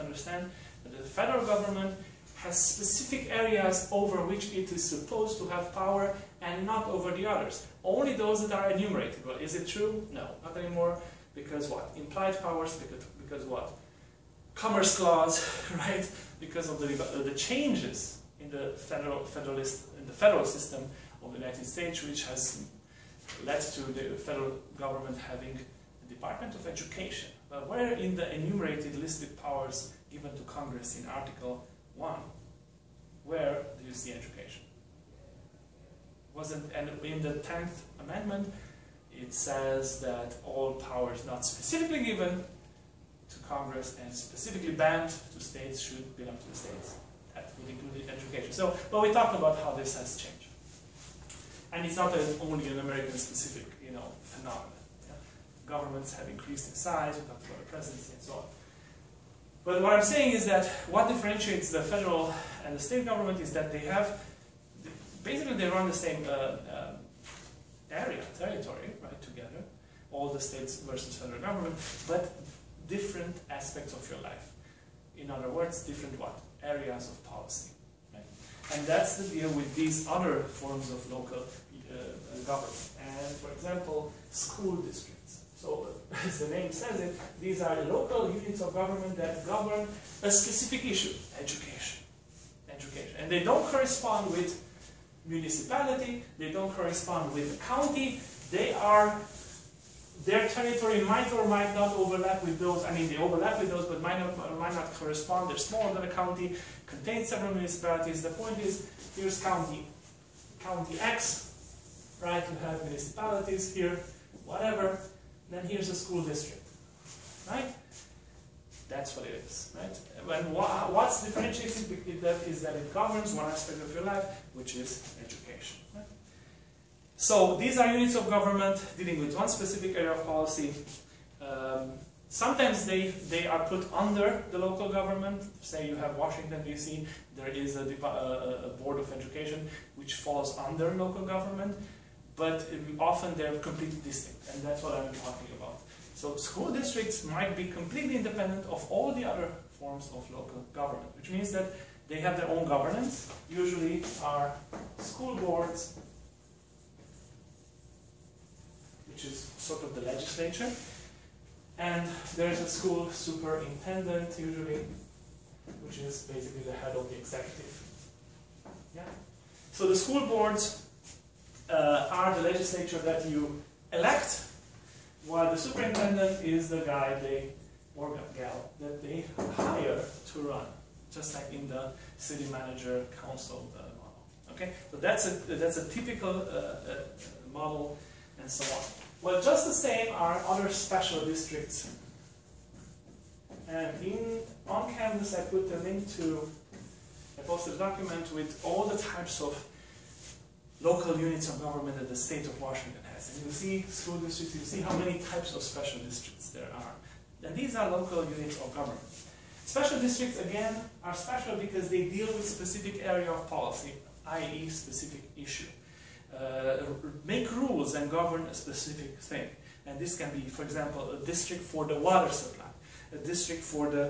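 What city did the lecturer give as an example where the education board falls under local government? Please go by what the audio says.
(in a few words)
Washington, D.C.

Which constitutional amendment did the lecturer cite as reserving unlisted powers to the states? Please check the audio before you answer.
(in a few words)
10th Amendment.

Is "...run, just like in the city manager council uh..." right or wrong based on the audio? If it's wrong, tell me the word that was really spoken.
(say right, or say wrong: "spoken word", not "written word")
right.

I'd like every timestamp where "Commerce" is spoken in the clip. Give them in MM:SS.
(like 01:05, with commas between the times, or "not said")
00:14.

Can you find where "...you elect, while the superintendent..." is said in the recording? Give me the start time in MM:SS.
02:53.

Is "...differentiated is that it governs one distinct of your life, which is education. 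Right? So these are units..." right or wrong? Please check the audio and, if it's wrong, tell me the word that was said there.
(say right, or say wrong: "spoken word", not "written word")
wrong: "aspect", not "distinct".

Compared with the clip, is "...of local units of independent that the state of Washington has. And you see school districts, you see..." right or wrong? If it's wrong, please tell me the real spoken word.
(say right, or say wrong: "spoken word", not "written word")
wrong: "government", not "independent".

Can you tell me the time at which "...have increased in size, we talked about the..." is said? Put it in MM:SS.
00:56.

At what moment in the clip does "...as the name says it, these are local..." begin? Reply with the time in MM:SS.
01:26.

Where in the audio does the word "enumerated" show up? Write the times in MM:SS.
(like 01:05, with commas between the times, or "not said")
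00:08, 00:28.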